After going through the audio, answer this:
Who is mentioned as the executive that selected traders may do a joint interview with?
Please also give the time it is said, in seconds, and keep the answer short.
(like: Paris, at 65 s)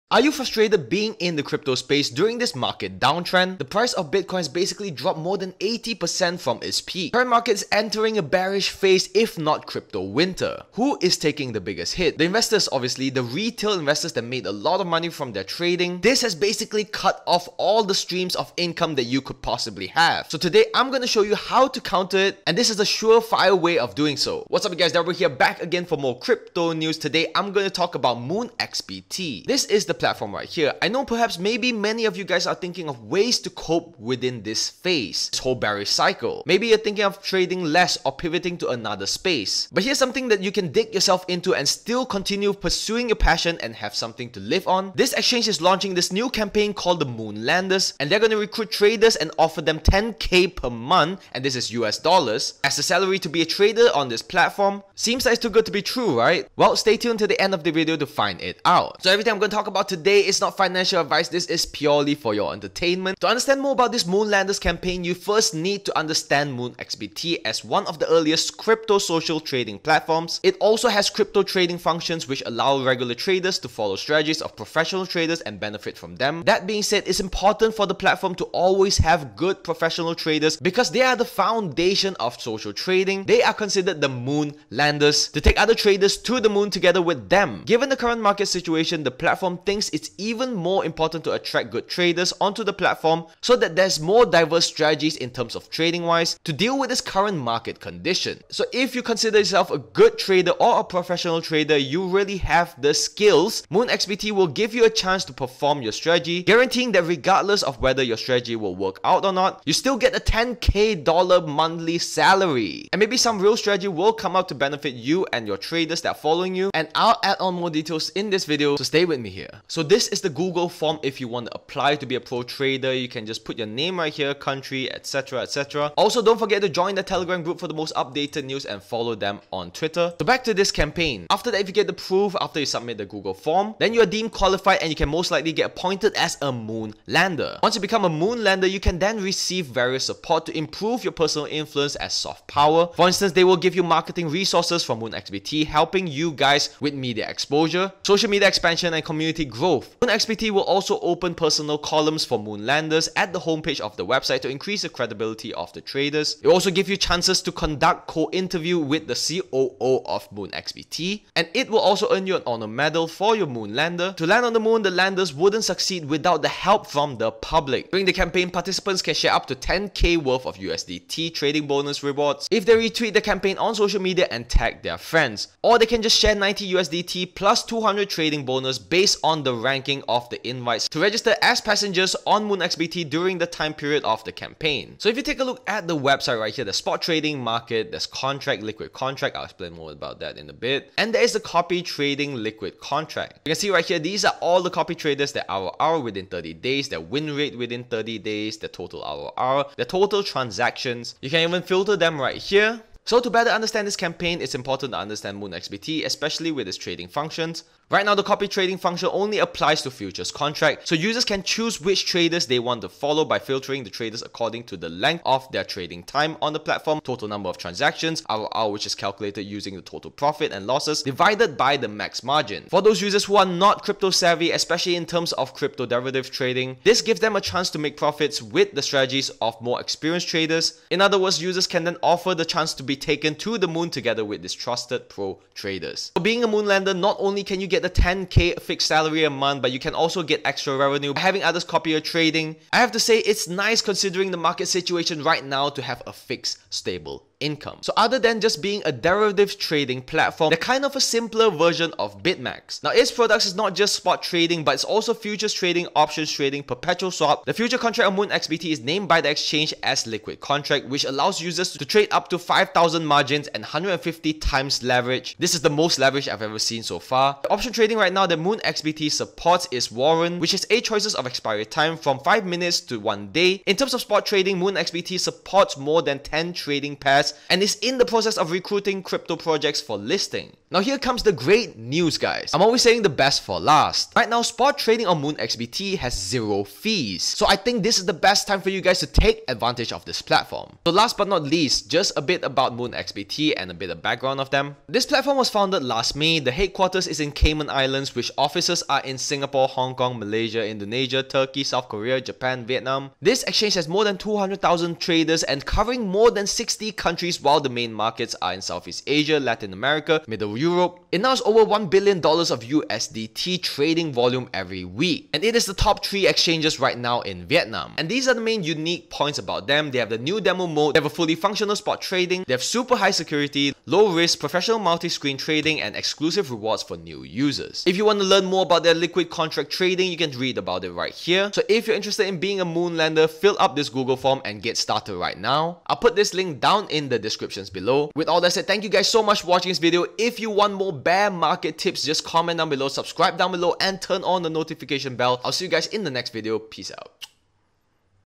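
the COO, at 159 s.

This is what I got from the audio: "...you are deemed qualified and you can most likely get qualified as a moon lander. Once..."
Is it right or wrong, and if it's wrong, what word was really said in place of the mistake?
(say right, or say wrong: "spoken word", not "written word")
wrong: "appointed", not "qualified".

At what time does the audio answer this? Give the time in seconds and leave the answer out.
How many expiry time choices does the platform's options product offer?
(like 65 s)
270 s.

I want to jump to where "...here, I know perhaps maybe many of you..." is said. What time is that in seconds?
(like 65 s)
30 s.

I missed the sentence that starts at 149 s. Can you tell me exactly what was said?
MoonXBT will also open personal columns for Moonlanders at the homepage of the website to increase the credibility of the traders.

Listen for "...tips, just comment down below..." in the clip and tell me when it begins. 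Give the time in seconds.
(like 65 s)
341 s.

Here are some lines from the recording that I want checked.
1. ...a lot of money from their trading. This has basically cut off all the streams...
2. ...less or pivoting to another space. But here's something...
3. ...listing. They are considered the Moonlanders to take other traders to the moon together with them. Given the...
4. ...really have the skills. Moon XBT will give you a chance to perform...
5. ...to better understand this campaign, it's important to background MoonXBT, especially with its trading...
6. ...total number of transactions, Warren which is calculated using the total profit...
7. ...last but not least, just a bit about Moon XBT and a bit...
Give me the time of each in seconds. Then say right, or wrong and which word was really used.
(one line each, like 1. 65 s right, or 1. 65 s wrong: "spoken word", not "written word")
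1. 14 s right
2. 37 s right
3. 82 s wrong: "trading", not "listing"
4. 102 s right
5. 203 s wrong: "understand", not "background"
6. 217 s wrong: "ROR", not "Warren"
7. 290 s right.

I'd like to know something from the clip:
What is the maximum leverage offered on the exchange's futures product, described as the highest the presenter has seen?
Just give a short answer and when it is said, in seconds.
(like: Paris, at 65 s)
150 times, at 263 s.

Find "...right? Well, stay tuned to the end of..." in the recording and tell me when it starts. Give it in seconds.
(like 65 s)
56 s.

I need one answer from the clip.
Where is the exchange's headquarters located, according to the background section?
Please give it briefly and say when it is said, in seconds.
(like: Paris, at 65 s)
Cayman Islands, at 297 s.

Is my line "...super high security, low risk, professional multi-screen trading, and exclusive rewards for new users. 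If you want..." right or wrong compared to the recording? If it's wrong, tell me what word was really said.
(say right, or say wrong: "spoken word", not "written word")
right.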